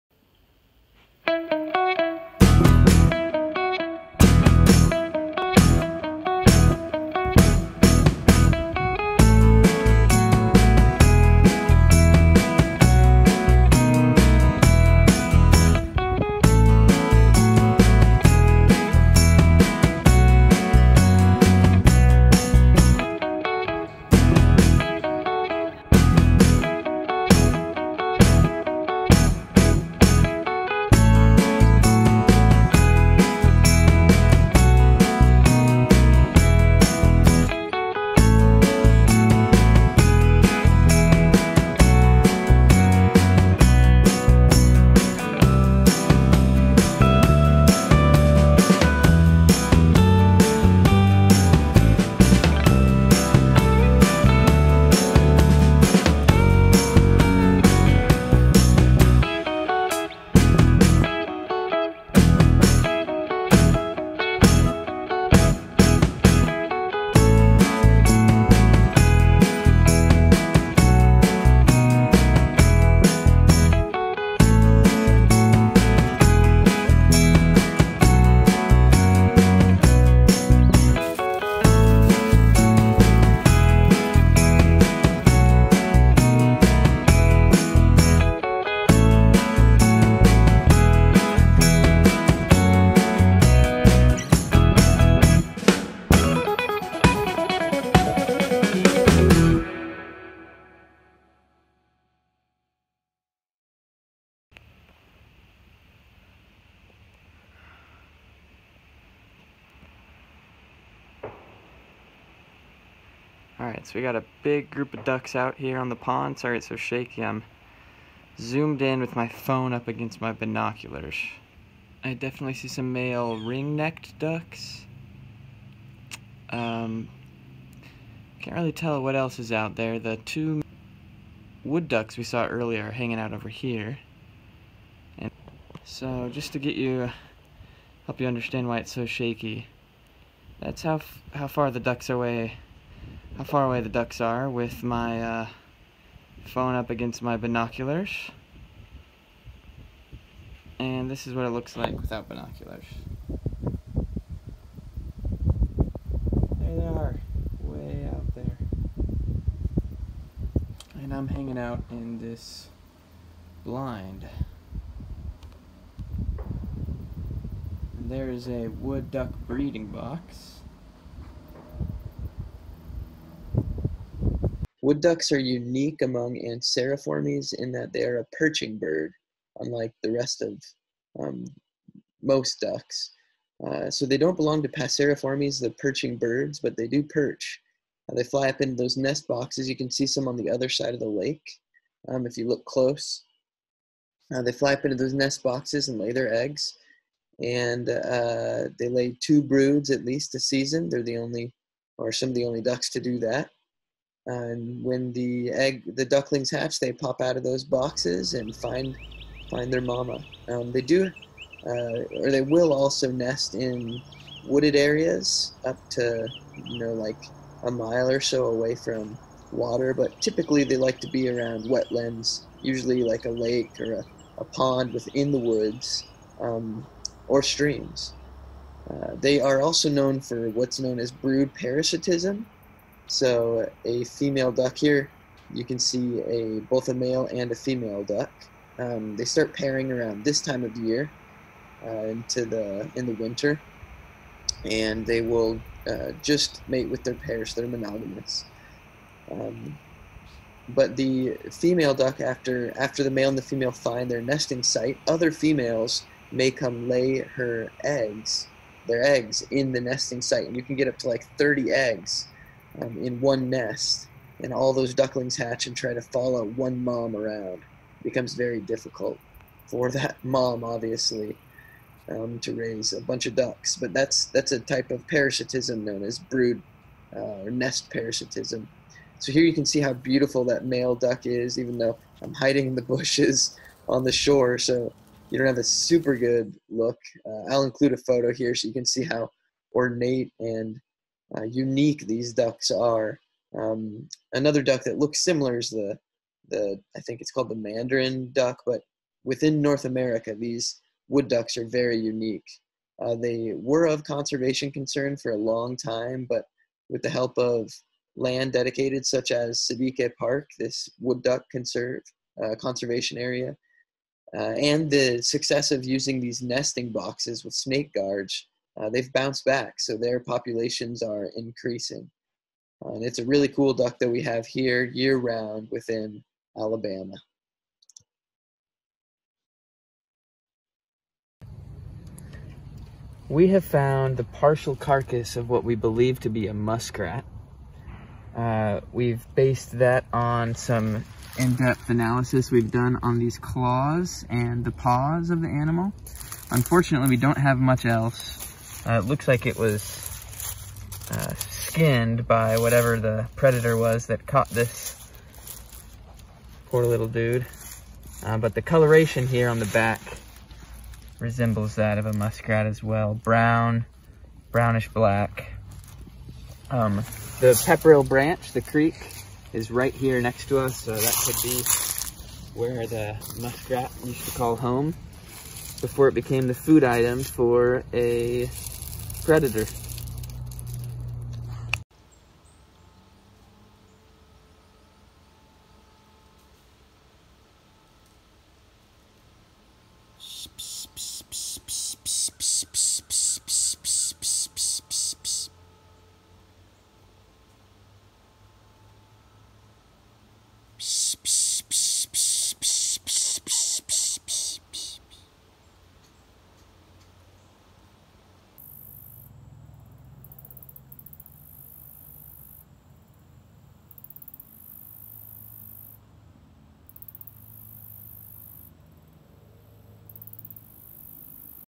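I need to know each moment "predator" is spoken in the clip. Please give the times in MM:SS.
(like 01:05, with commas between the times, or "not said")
05:53, 06:19.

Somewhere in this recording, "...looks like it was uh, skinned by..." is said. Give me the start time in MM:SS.
05:49.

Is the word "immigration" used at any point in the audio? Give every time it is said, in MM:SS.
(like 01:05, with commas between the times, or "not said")
not said.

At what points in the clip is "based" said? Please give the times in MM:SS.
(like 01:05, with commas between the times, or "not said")
05:39.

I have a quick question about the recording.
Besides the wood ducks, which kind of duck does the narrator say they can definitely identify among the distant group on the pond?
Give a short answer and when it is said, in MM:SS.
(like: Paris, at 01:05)
ring-necked ducks, at 02:03.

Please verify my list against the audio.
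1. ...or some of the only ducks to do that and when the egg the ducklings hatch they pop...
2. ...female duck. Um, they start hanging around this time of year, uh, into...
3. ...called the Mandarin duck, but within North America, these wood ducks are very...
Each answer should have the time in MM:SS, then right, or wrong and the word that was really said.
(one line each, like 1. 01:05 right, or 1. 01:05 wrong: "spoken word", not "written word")
1. 03:21 right
2. 03:57 wrong: "pairing", not "hanging"
3. 04:57 right.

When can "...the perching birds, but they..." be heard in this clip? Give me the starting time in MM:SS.
03:05.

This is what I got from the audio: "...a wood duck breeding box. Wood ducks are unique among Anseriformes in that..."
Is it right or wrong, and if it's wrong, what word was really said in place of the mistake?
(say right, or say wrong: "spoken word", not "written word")
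right.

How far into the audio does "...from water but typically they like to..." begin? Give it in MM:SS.
03:38.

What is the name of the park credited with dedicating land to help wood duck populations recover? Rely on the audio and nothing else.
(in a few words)
Siddique Park.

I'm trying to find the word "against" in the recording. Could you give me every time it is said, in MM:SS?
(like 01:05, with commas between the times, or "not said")
01:59, 02:26.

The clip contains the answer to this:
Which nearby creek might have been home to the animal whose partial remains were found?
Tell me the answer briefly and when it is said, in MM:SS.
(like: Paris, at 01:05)
Pepperell Branch, at 06:07.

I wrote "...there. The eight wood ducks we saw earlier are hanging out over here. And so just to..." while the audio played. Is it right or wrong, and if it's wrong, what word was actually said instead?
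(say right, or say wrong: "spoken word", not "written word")
wrong: "two", not "eight".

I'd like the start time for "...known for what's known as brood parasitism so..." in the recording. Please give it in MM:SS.
03:49.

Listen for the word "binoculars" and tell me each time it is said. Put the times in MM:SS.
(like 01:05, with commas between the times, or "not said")
02:00, 02:27, 02:32.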